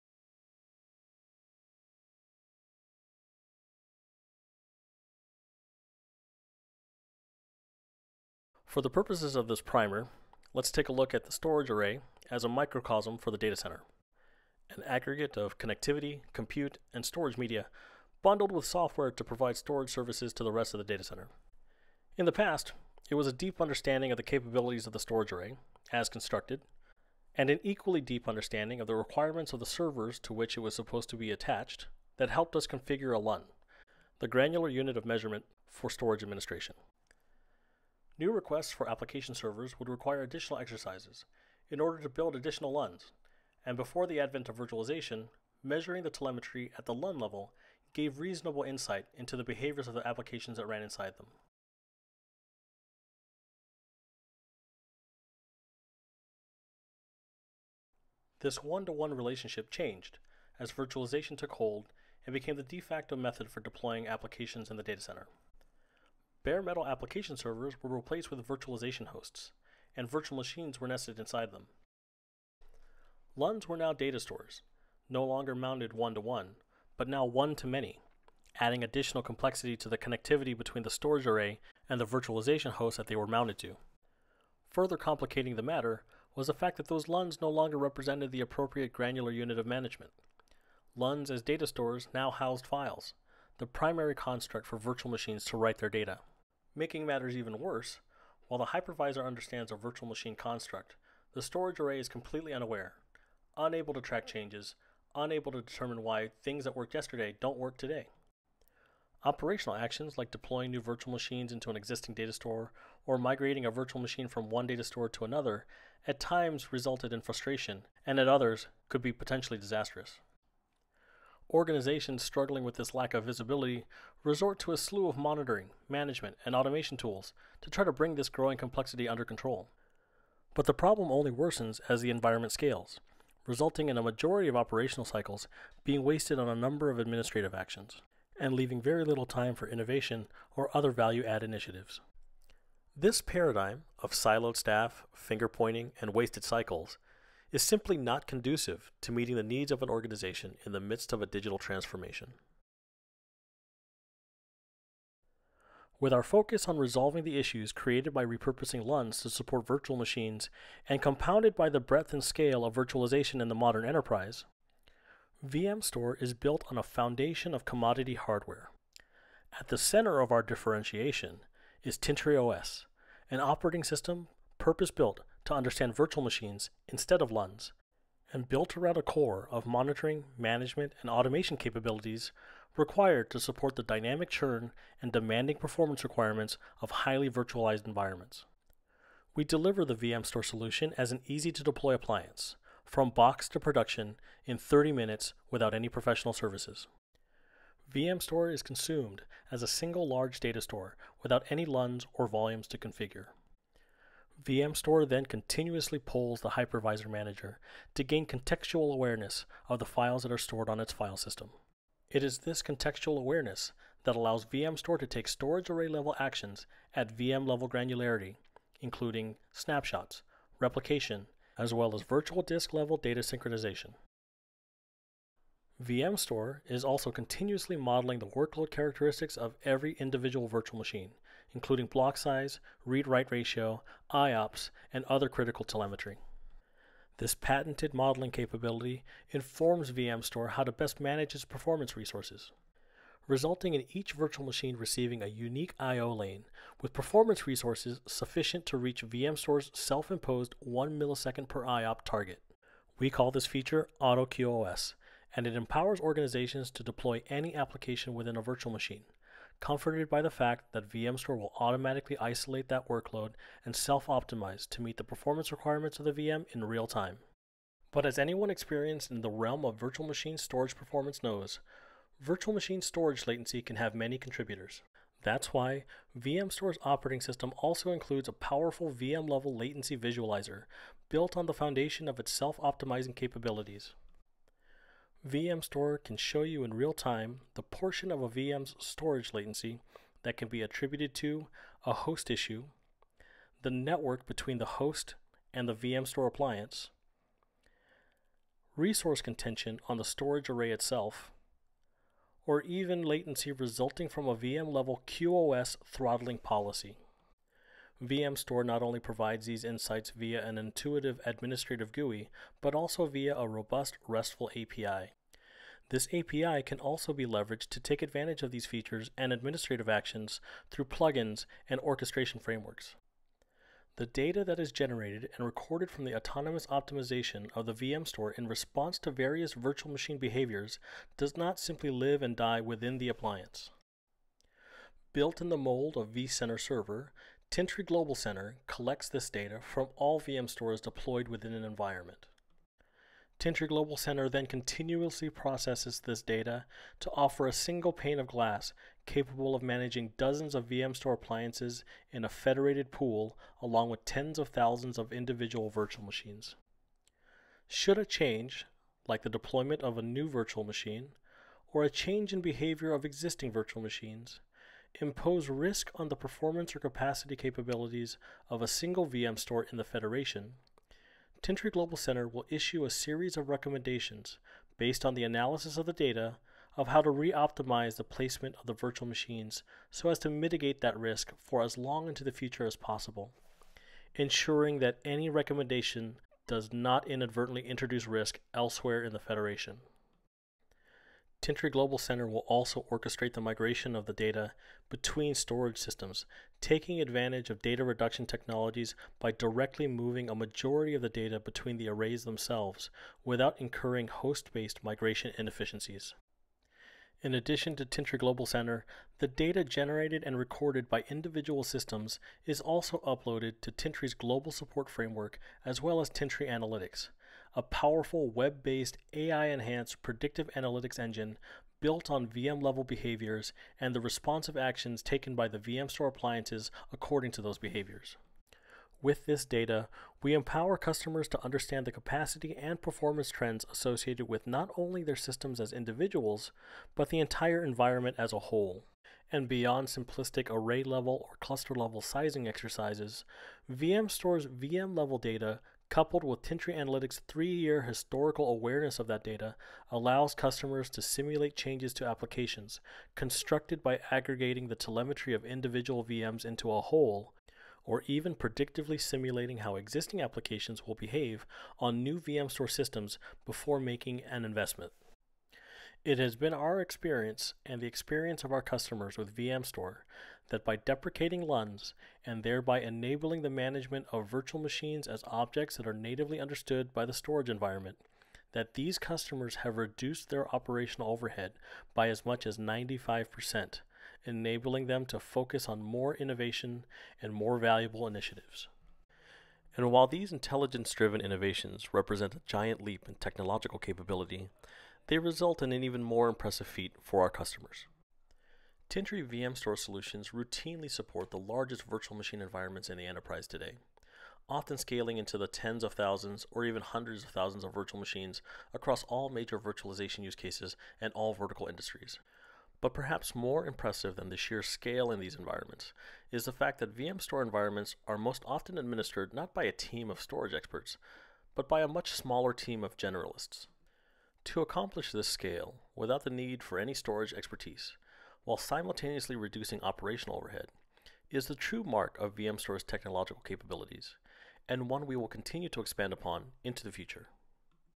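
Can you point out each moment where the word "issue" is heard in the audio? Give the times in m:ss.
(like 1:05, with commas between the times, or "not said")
2:37, 4:52, 6:12.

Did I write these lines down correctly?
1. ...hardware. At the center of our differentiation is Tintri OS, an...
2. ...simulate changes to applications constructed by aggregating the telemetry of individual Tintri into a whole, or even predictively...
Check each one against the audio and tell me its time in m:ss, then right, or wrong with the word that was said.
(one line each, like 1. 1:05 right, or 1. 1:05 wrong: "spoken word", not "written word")
1. 2:48 right
2. 7:31 wrong: "VMs", not "Tintri".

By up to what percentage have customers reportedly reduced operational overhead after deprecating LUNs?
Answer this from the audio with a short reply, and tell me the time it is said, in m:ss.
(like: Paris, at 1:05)
95%, at 8:02.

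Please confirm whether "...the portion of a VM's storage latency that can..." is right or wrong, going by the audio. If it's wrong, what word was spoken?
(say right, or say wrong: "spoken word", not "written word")
right.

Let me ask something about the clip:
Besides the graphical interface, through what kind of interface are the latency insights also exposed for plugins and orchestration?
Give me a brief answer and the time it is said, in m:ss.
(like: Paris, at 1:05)
RESTful API, at 5:14.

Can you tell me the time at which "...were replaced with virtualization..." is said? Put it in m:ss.
1:07.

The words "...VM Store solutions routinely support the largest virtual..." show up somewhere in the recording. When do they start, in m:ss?
8:19.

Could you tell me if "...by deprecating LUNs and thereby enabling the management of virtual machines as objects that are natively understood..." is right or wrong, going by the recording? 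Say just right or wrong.
right.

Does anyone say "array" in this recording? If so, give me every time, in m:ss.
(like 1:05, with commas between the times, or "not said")
0:11, 0:25, 1:21, 1:41, 3:35, 5:00, 6:41, 7:20.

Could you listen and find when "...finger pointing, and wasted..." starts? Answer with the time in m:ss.
2:25.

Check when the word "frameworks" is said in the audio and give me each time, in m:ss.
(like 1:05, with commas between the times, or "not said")
5:22, 6:54.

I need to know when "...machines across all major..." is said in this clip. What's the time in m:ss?
8:28.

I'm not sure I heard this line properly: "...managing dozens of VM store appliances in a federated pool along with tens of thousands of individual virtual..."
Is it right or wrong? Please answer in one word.
right.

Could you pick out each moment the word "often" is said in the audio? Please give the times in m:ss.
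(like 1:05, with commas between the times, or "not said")
8:24, 8:38.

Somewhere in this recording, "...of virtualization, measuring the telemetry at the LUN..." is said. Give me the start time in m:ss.
0:44.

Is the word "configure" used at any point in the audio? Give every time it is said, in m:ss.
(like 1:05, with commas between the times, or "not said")
0:32, 3:22.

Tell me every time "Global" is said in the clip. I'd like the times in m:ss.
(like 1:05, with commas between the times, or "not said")
5:37, 5:43, 6:11, 6:31, 6:48, 6:54.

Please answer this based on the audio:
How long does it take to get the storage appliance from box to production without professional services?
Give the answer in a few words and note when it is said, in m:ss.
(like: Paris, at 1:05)
30 minutes, at 3:14.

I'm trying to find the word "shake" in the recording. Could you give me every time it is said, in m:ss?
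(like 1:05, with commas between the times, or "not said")
not said.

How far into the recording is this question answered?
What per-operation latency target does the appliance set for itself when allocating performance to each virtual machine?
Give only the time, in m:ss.
4:10.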